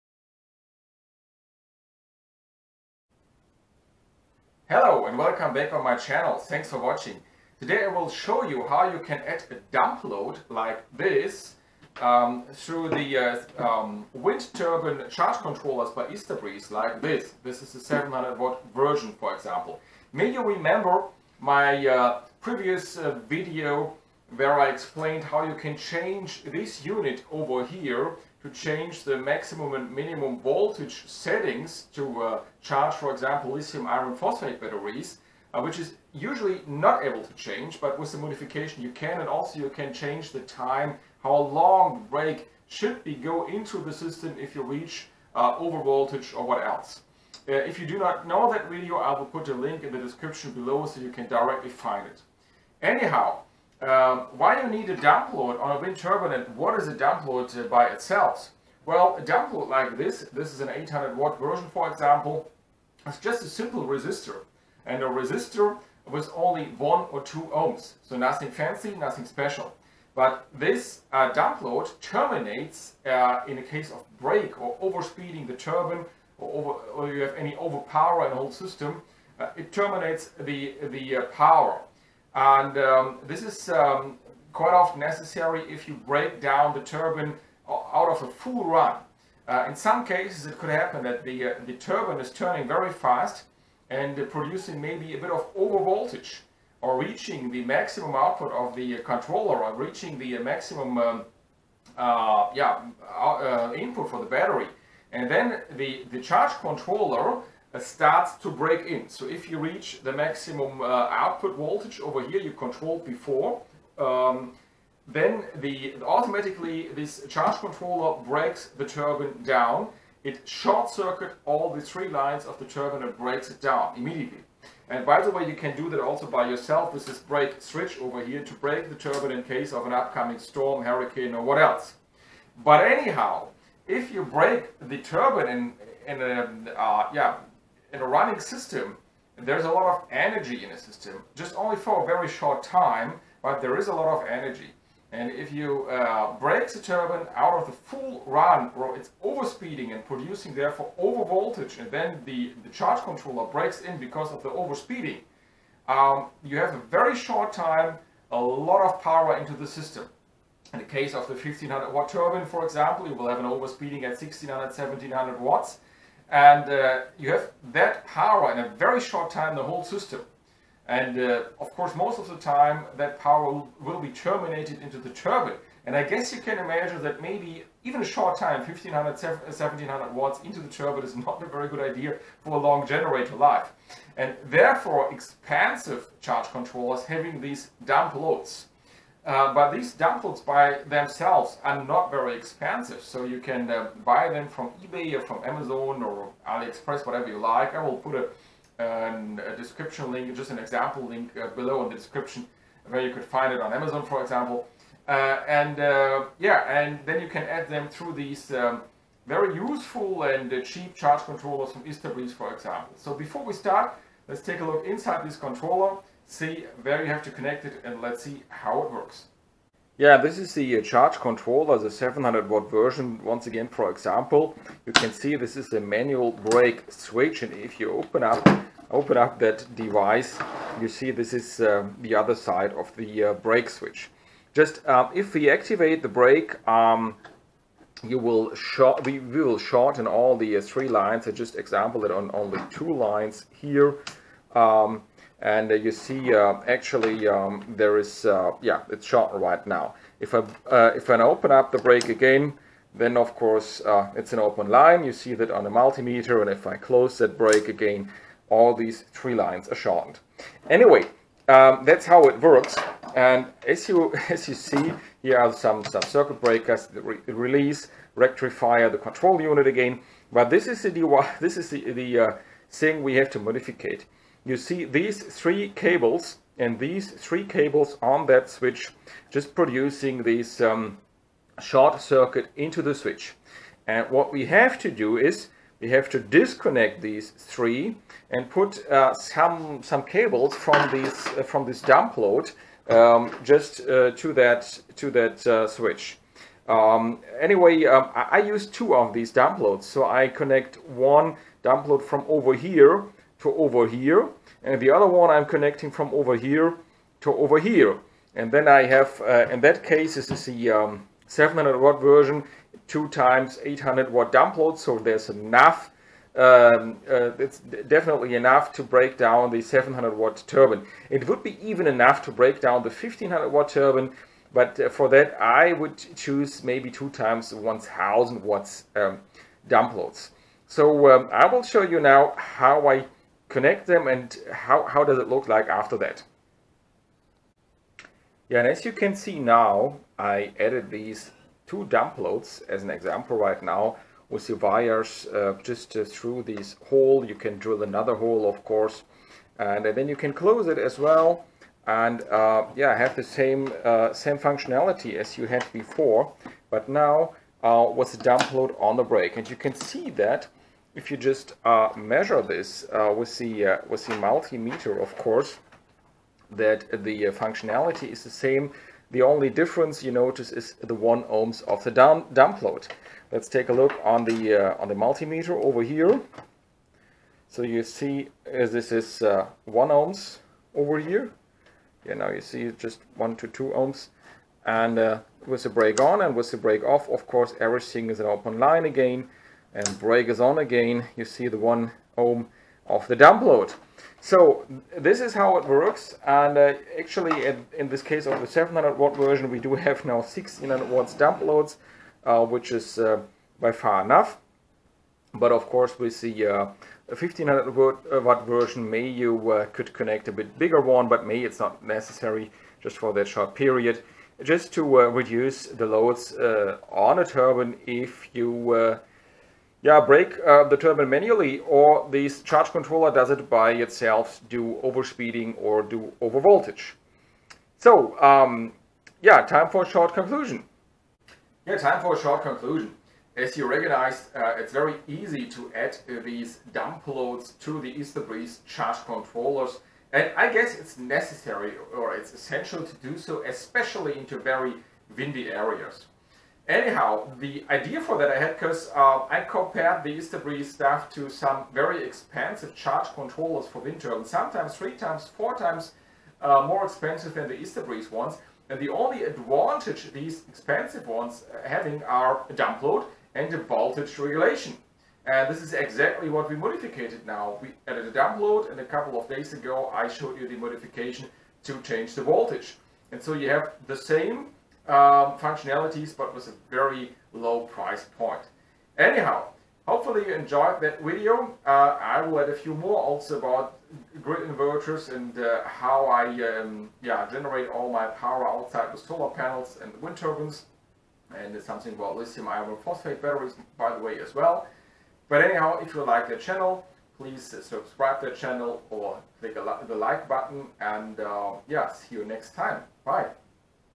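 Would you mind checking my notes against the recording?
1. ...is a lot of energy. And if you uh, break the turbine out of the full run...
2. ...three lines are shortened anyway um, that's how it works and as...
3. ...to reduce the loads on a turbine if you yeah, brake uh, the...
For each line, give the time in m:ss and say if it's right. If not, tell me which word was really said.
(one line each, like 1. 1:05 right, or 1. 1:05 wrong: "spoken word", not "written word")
1. 2:23 right
2. 4:19 right
3. 6:54 right.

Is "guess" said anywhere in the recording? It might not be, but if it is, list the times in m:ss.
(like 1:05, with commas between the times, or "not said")
2:56, 7:20.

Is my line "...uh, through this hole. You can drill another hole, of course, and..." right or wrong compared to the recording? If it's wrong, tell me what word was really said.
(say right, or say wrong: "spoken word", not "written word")
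right.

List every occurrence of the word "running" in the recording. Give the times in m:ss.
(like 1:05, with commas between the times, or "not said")
2:18.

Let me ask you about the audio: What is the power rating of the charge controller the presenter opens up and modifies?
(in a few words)
700 watt.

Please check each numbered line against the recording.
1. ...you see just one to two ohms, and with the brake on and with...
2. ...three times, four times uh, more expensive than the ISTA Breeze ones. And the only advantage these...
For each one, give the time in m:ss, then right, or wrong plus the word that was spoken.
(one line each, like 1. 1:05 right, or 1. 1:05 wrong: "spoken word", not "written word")
1. 6:22 right
2. 7:34 right.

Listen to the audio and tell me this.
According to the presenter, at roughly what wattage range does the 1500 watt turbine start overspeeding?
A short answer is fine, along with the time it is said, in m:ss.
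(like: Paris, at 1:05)
1600 to 1700 watts, at 2:44.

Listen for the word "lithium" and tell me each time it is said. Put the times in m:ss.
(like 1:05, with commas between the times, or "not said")
0:33, 8:12.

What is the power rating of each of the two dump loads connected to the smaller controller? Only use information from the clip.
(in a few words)
800 watt.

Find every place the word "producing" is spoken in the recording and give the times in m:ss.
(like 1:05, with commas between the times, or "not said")
1:34, 2:30, 4:39.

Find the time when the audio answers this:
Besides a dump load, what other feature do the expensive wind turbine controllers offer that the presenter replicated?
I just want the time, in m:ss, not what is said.
7:43.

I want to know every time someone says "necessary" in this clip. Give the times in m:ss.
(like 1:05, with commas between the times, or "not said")
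1:24, 6:51, 7:20.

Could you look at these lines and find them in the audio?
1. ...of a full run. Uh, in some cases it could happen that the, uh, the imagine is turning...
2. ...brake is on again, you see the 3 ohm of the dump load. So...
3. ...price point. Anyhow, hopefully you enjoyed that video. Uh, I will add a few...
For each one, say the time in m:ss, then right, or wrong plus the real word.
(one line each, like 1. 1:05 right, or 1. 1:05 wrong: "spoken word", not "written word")
1. 1:28 wrong: "turbine", not "imagine"
2. 6:29 wrong: "1", not "3"
3. 7:57 right.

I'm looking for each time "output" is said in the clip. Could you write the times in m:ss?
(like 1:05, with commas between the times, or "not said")
1:38, 1:51.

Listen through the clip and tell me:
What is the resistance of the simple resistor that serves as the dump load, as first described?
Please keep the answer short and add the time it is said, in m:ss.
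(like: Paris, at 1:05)
1 or 2 ohms, at 1:06.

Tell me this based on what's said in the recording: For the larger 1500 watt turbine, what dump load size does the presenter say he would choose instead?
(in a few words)
2 times 1000 watts.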